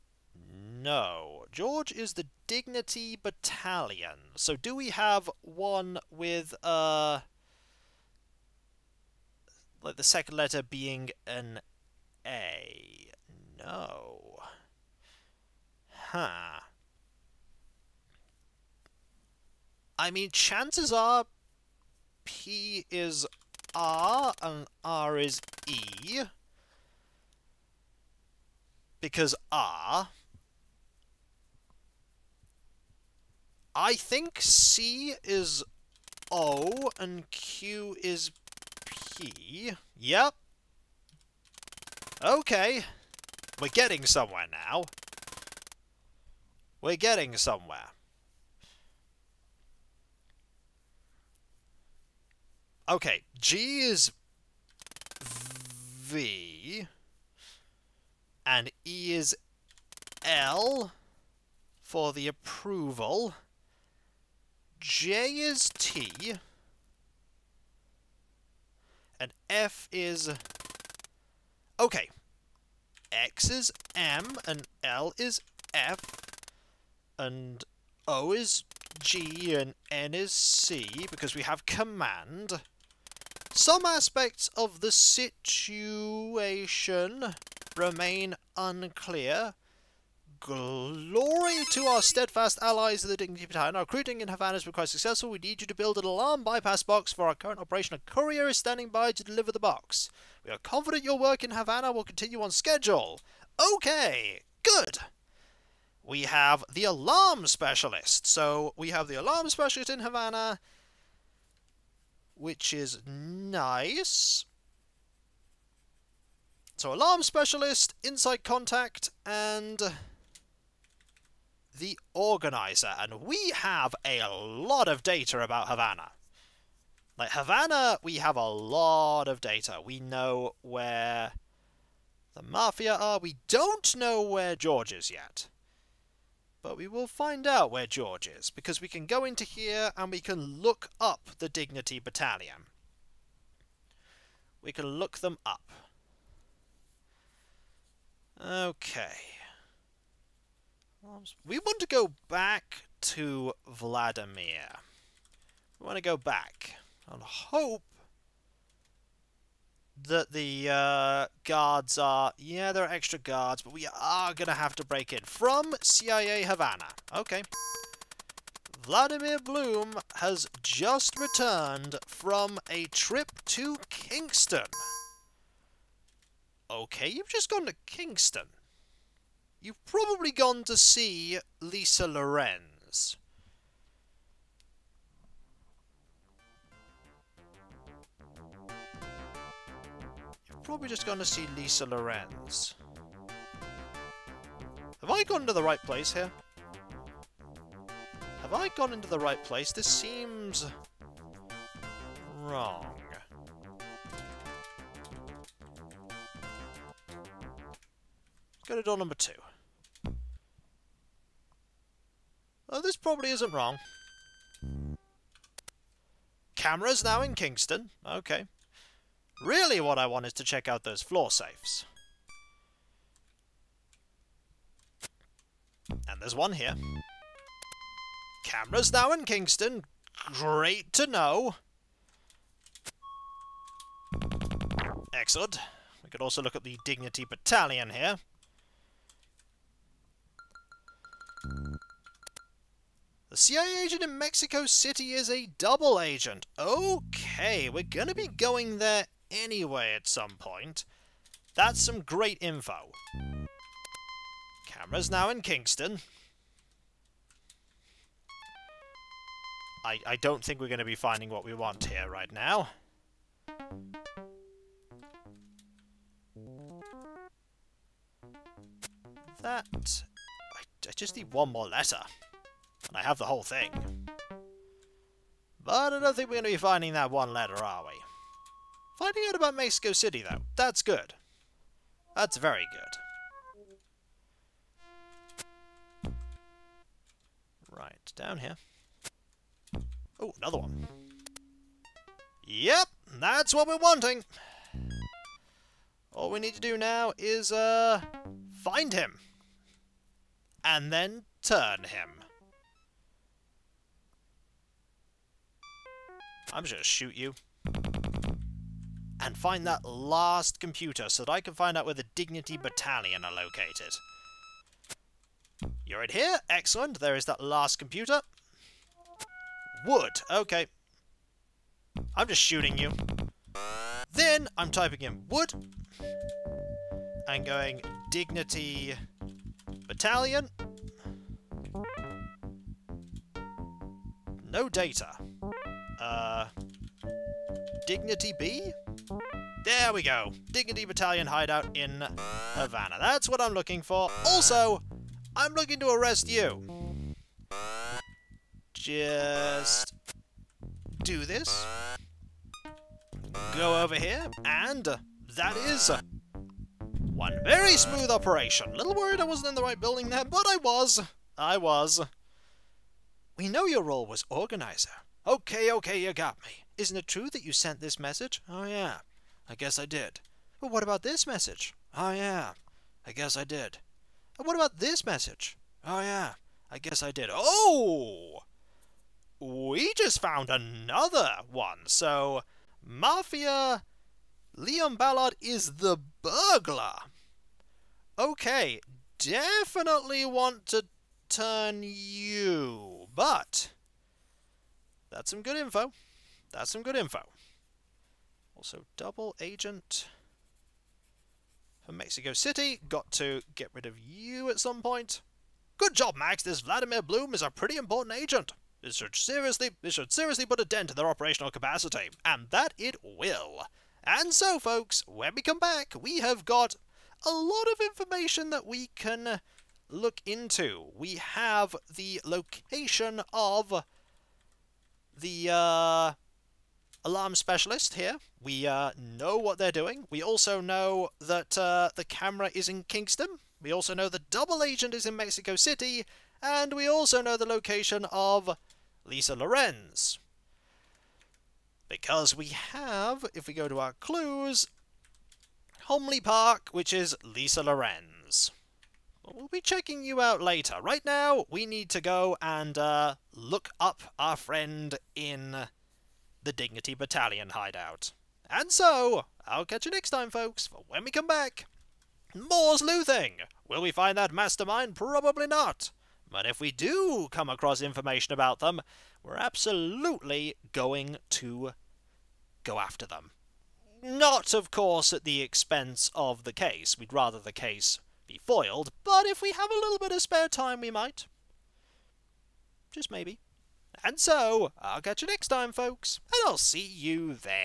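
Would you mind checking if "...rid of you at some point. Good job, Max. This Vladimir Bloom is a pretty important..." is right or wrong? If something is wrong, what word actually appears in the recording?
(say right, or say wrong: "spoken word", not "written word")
right.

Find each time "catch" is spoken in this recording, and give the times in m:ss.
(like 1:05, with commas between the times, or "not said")
7:39, 8:04.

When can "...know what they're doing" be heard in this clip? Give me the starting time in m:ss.
7:08.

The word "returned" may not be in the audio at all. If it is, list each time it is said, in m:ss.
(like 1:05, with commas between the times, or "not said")
2:51.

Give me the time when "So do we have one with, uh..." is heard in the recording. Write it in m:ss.
0:04.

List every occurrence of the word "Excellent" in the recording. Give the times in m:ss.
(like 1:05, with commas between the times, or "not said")
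3:55, 5:16.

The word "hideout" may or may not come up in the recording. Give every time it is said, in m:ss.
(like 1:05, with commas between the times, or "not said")
5:41, 7:37.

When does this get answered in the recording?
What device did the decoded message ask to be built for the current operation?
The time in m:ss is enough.
1:36.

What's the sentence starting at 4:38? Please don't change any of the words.
Finding out about Mexico City, though, that's good.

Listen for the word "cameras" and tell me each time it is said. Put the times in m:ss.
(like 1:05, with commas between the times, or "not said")
3:36, 3:48, 4:14, 7:12.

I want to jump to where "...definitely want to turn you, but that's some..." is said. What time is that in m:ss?
6:29.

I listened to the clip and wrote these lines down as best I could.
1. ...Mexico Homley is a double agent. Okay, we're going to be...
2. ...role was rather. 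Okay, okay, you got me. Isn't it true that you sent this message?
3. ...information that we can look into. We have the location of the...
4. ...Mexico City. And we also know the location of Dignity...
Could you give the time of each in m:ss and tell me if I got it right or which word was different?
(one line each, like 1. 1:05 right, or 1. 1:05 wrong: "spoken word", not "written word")
1. 4:04 wrong: "City", not "Homley"
2. 6:03 wrong: "organizer", not "rather"
3. 6:57 right
4. 7:15 wrong: "Lisa", not "Dignity".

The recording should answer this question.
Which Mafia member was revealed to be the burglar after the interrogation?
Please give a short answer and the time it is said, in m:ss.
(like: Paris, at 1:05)
Leon Ballard, at 6:24.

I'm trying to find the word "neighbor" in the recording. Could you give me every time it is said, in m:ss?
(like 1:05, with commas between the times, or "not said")
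not said.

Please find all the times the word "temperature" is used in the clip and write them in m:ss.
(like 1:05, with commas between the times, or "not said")
not said.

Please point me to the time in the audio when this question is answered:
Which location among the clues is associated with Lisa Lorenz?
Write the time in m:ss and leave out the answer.
7:25.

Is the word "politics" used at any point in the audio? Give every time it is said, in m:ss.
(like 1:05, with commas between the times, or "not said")
not said.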